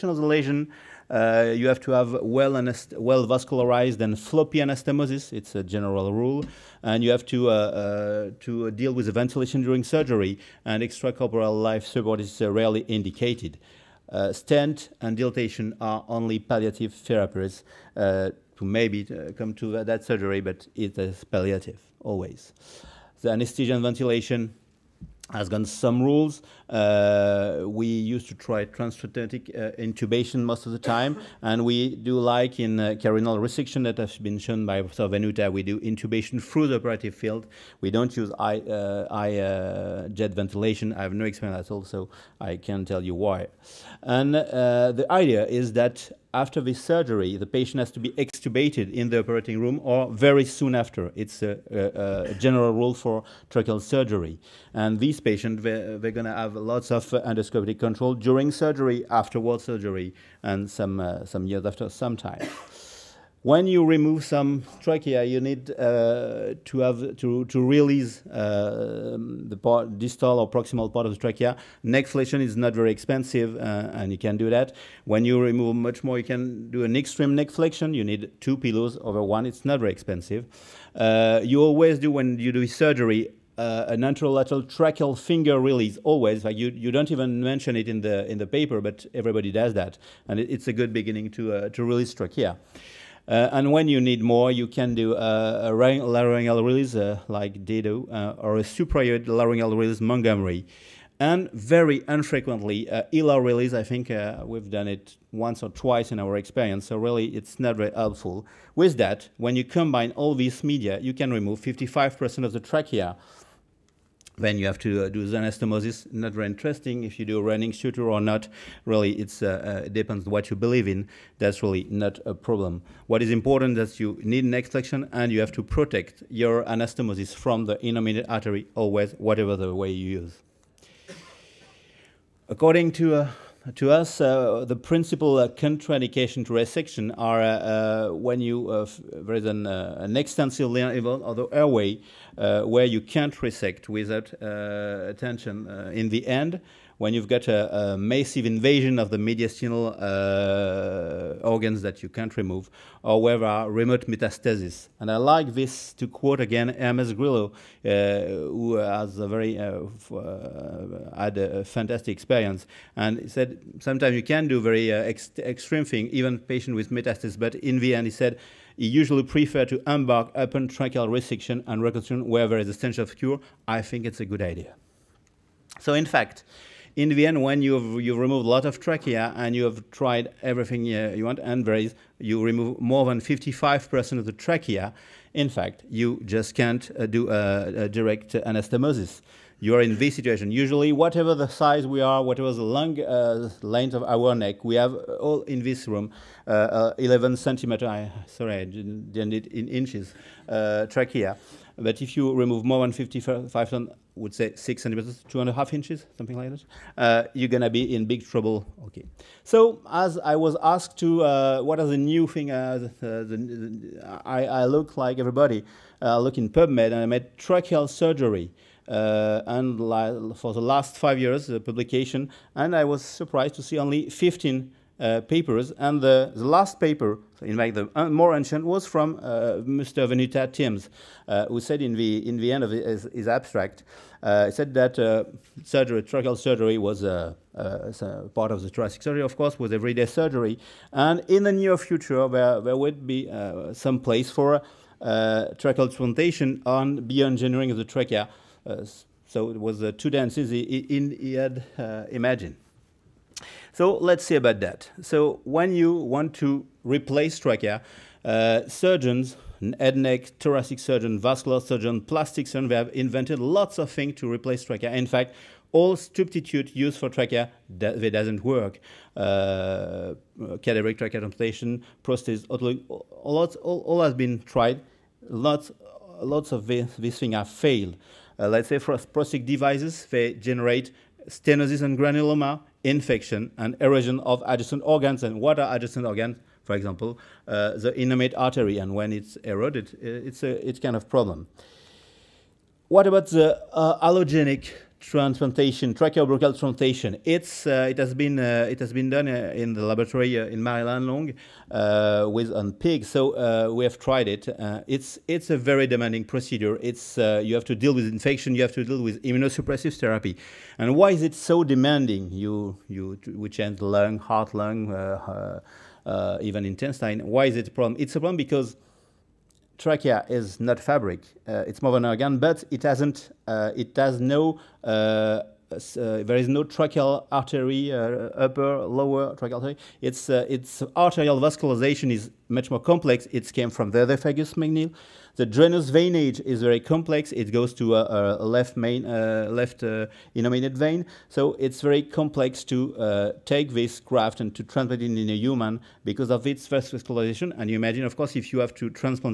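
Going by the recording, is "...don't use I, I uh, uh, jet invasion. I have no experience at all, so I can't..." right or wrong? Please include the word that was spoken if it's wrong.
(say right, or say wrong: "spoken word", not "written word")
wrong: "ventilation", not "invasion".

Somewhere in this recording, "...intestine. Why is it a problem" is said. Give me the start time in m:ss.
5:16.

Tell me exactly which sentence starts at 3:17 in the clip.
I, sorry, I didn't, did in inches.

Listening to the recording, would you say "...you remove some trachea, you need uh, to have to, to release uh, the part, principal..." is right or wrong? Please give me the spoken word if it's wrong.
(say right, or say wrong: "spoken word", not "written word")
wrong: "distal", not "principal".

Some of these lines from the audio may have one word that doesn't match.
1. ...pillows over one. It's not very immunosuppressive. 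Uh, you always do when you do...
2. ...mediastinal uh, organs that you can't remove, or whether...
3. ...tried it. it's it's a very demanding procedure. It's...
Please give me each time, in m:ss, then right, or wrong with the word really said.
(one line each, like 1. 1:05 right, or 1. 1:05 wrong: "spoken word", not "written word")
1. 1:18 wrong: "expensive", not "immunosuppressive"
2. 2:29 right
3. 5:03 right.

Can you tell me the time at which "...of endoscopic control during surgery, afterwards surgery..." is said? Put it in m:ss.
0:56.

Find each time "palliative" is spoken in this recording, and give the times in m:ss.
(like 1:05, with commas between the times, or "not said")
0:16, 0:21.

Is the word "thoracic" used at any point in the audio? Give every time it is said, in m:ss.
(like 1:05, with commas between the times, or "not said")
3:58, 4:20.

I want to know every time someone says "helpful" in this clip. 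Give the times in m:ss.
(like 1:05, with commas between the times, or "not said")
1:47.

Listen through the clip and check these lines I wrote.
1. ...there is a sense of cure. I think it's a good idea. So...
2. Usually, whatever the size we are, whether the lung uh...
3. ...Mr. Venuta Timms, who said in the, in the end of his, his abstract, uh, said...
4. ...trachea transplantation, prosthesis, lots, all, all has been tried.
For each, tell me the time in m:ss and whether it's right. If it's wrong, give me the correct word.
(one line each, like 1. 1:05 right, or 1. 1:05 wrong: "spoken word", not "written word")
1. 2:52 right
2. 3:10 wrong: "whatever", not "whether"
3. 3:49 right
4. 4:30 right.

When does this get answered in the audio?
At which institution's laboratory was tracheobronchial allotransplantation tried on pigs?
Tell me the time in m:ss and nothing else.
5:00.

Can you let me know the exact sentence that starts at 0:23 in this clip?
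The anesthesia and ventilation has gone some rules.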